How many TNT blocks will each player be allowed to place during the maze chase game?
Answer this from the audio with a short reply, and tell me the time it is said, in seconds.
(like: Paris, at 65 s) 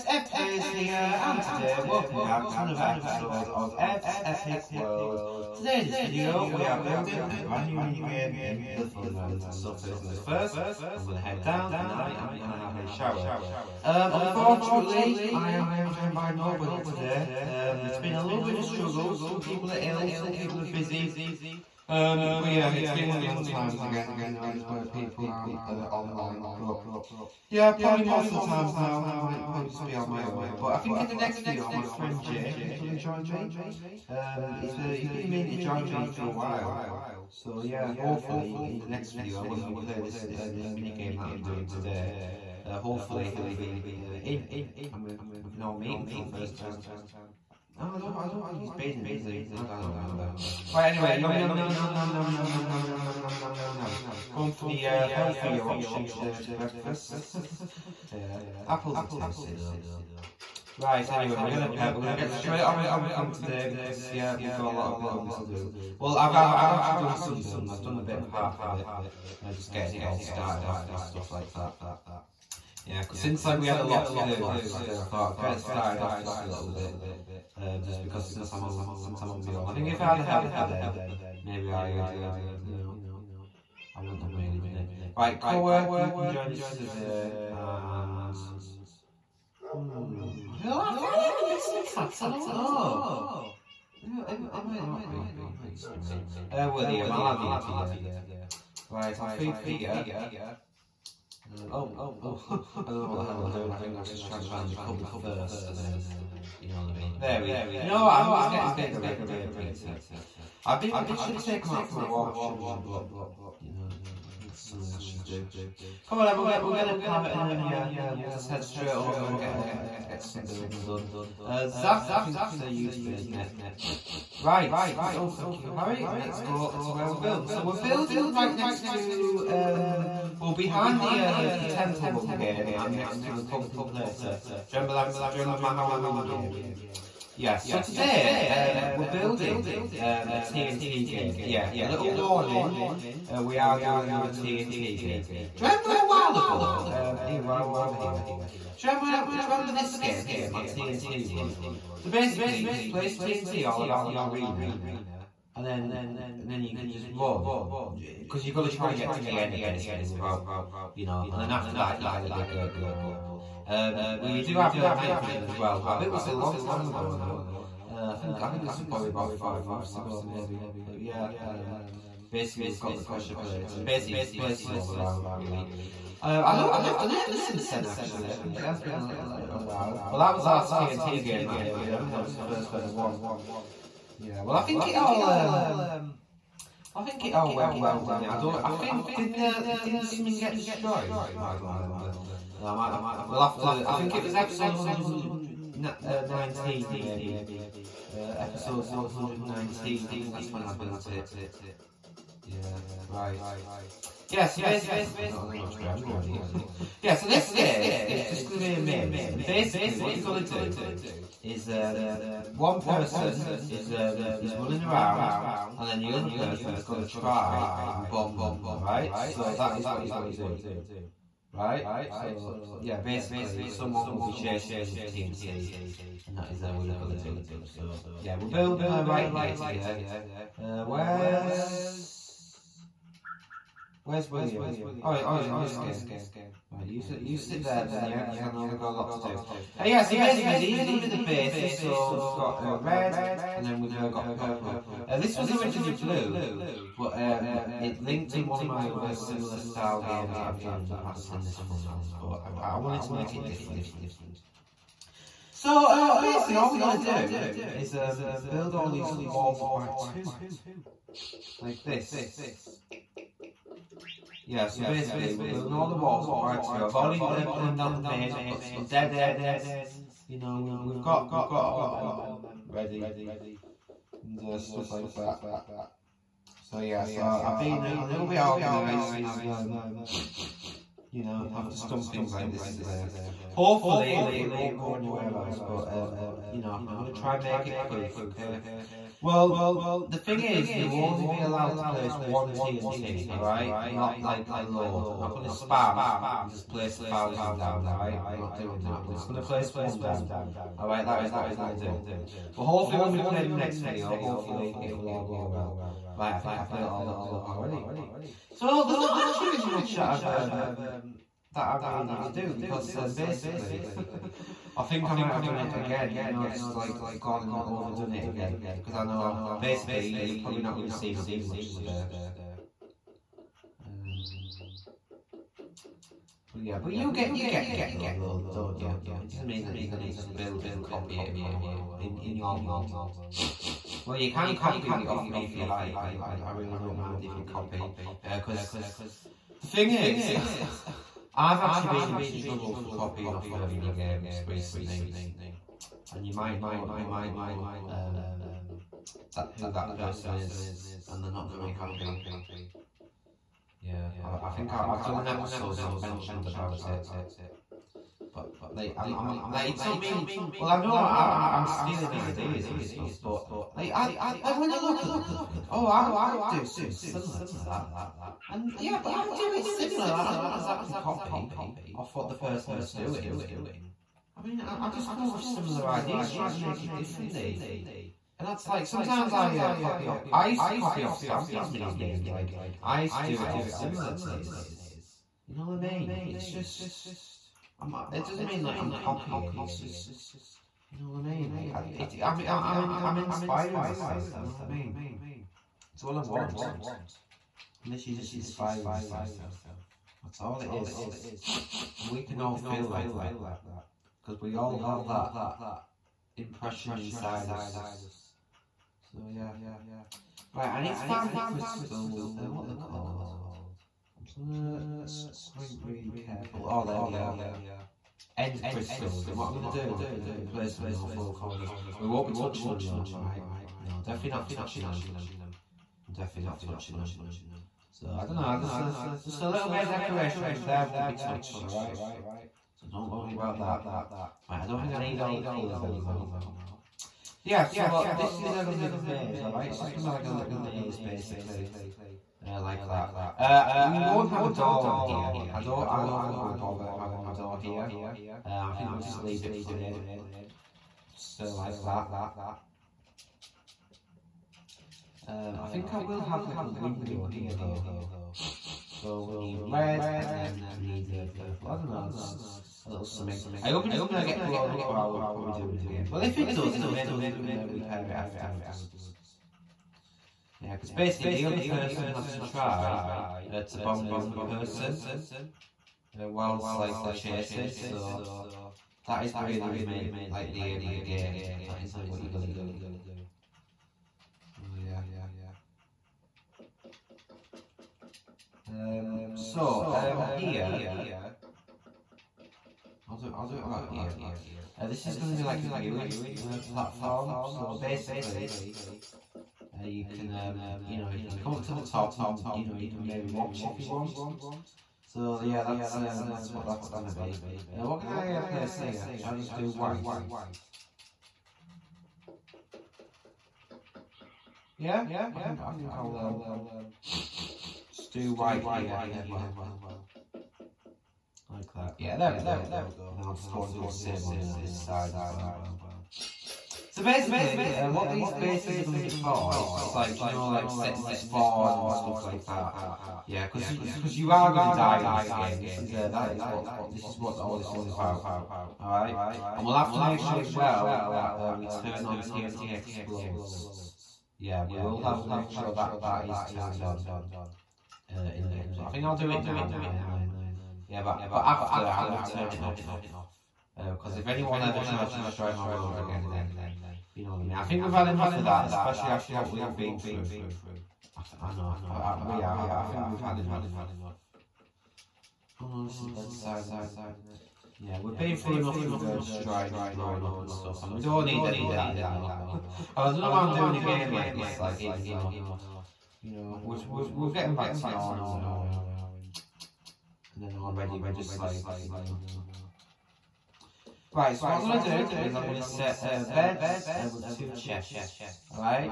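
1, at 292 s.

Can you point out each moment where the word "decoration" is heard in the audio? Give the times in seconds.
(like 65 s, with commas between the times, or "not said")
429 s.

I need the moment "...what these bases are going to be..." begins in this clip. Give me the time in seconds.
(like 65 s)
527 s.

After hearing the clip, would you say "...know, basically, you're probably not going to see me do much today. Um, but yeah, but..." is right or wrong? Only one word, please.
right.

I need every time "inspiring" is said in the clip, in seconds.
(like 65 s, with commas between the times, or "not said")
393 s, 398 s.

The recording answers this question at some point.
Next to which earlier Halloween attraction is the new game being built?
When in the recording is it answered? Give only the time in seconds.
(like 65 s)
133 s.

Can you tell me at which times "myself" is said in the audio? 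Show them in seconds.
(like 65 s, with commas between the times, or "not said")
393 s, 398 s.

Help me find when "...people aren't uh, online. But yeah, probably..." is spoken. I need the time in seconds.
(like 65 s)
24 s.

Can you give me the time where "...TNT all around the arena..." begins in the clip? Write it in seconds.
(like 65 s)
153 s.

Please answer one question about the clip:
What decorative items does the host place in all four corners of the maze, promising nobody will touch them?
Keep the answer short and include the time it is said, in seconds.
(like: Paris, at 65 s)
End crystals, at 418 s.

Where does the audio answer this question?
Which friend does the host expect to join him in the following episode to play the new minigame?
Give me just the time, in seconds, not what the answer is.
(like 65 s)
32 s.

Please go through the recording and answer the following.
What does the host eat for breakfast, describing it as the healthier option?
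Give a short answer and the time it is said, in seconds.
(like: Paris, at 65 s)
Apples, at 58 s.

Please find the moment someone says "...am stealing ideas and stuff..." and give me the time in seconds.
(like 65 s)
361 s.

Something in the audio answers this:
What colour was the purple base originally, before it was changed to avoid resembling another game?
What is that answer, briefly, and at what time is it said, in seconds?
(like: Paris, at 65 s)
Blue, at 245 s.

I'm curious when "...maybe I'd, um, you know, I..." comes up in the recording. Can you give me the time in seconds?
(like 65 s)
81 s.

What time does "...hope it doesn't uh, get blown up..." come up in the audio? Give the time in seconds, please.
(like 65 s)
463 s.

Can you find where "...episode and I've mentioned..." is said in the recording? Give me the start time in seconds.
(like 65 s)
355 s.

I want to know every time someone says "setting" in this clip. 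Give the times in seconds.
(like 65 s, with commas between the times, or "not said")
530 s.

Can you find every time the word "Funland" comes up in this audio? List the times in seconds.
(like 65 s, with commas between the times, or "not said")
8 s, 251 s.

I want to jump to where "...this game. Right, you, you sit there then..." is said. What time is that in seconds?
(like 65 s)
235 s.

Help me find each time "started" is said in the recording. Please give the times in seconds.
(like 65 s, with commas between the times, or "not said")
70 s, 75 s.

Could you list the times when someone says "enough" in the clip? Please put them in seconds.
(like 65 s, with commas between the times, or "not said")
558 s, 563 s, 568 s.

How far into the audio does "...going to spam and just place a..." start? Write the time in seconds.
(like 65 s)
295 s.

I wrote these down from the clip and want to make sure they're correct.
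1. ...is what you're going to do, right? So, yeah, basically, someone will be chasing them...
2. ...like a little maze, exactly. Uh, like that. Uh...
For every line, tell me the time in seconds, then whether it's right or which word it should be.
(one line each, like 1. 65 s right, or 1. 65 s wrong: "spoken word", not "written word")
1. 219 s right
2. 440 s wrong: "basically", not "exactly".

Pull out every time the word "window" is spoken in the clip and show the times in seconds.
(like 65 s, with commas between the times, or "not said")
456 s.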